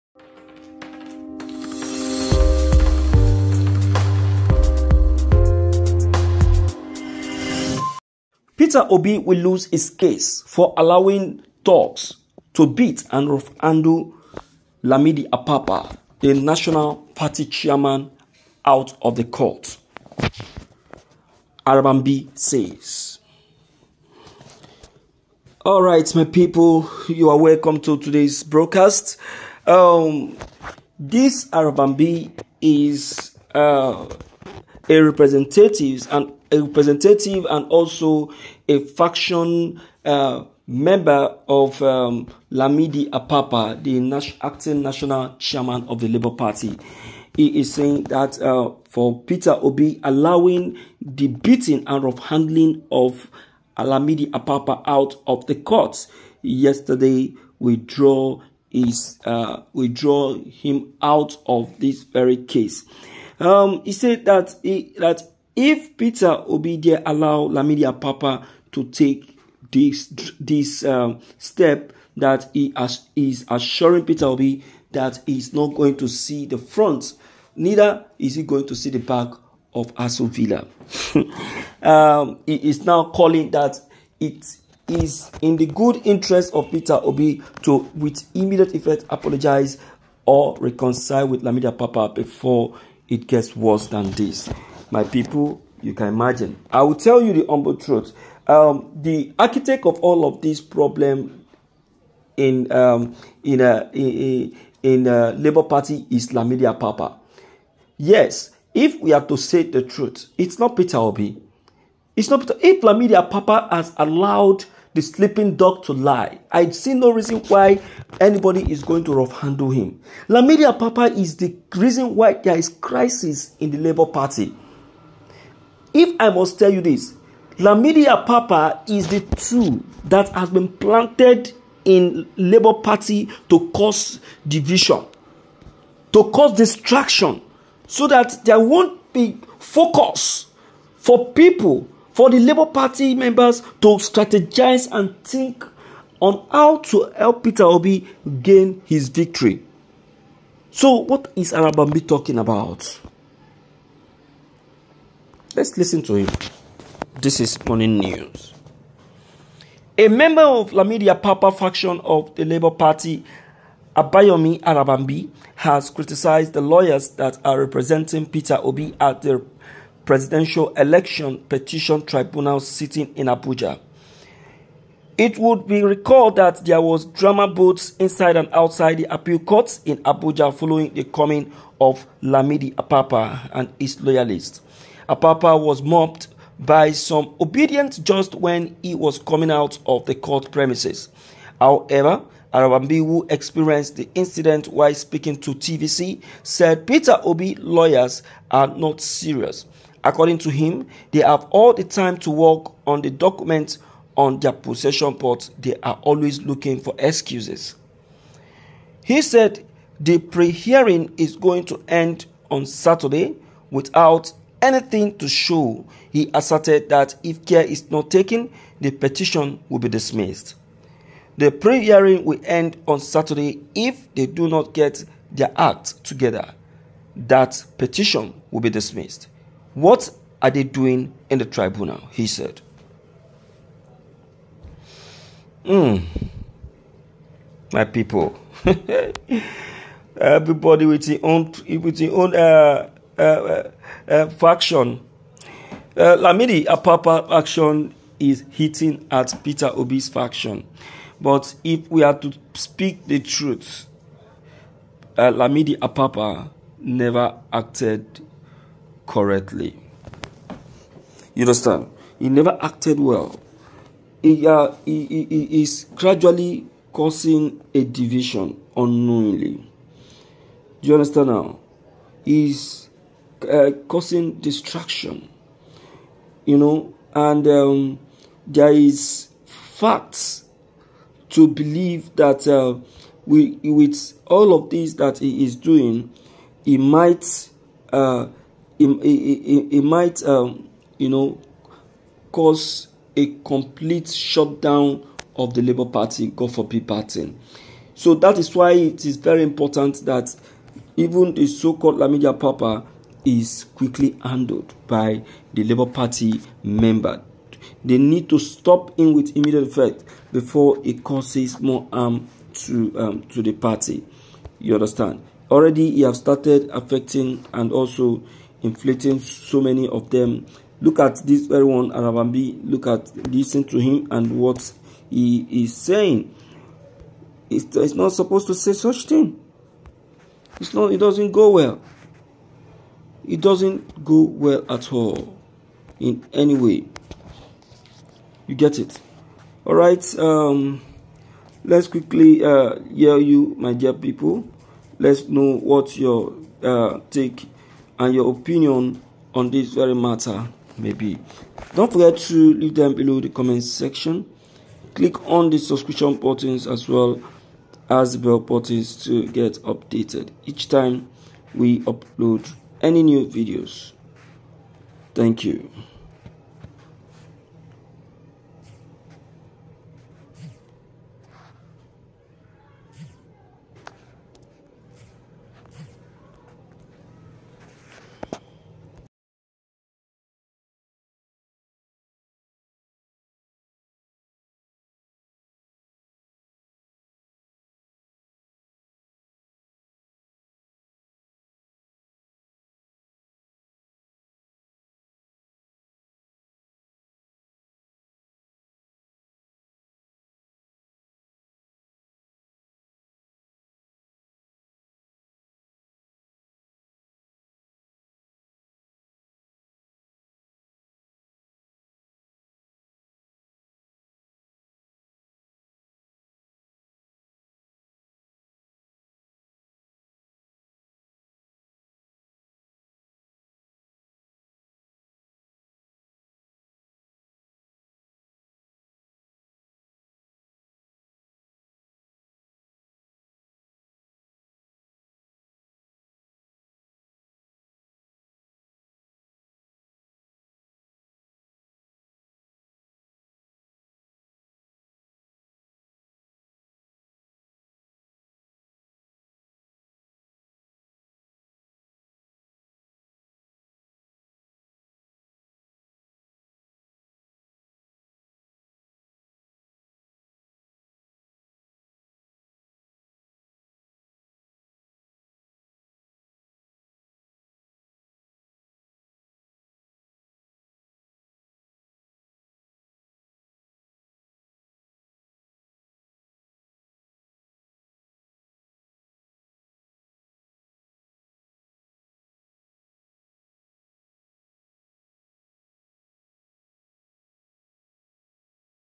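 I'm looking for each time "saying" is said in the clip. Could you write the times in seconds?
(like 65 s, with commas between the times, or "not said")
47 s, 325 s.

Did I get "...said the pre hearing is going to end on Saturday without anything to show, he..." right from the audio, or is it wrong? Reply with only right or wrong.
right.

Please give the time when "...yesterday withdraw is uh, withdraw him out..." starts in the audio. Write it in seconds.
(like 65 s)
56 s.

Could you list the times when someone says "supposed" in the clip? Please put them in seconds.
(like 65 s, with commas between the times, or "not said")
328 s.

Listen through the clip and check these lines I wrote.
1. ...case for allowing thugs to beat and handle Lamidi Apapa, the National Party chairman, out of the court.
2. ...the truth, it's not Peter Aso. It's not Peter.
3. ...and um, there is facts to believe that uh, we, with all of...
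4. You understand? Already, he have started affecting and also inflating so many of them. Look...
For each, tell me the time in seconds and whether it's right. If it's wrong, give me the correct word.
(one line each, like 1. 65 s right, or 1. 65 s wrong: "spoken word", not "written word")
1. 9 s right
2. 109 s wrong: "Obi", not "Aso"
3. 277 s right
4. 314 s right.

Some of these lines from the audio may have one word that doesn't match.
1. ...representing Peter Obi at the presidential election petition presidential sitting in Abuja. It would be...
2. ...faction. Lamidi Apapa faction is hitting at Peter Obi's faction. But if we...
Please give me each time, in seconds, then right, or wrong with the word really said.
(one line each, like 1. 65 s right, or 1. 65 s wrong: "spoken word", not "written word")
1. 167 s wrong: "tribunal", not "presidential"
2. 244 s right.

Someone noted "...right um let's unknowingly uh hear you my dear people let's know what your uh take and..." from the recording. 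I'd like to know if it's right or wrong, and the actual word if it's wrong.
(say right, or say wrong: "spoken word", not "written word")
wrong: "quickly", not "unknowingly".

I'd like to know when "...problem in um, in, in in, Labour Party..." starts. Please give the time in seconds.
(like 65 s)
100 s.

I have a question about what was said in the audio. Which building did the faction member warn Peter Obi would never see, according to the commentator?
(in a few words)
Aso Villa.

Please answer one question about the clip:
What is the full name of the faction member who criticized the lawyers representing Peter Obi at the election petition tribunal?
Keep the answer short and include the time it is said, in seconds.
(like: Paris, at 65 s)
Abayomi Arabambi, at 163 s.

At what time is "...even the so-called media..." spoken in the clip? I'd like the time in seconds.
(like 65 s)
300 s.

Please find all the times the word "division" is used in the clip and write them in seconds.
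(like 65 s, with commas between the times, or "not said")
134 s, 267 s.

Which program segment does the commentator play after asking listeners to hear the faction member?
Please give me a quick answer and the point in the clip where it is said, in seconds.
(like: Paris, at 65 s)
Morning news, at 157 s.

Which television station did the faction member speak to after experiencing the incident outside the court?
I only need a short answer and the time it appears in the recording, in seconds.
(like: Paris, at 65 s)
TVC, at 195 s.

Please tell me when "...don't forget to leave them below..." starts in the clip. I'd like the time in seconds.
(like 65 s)
351 s.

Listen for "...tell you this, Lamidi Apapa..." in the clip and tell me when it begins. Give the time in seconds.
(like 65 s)
126 s.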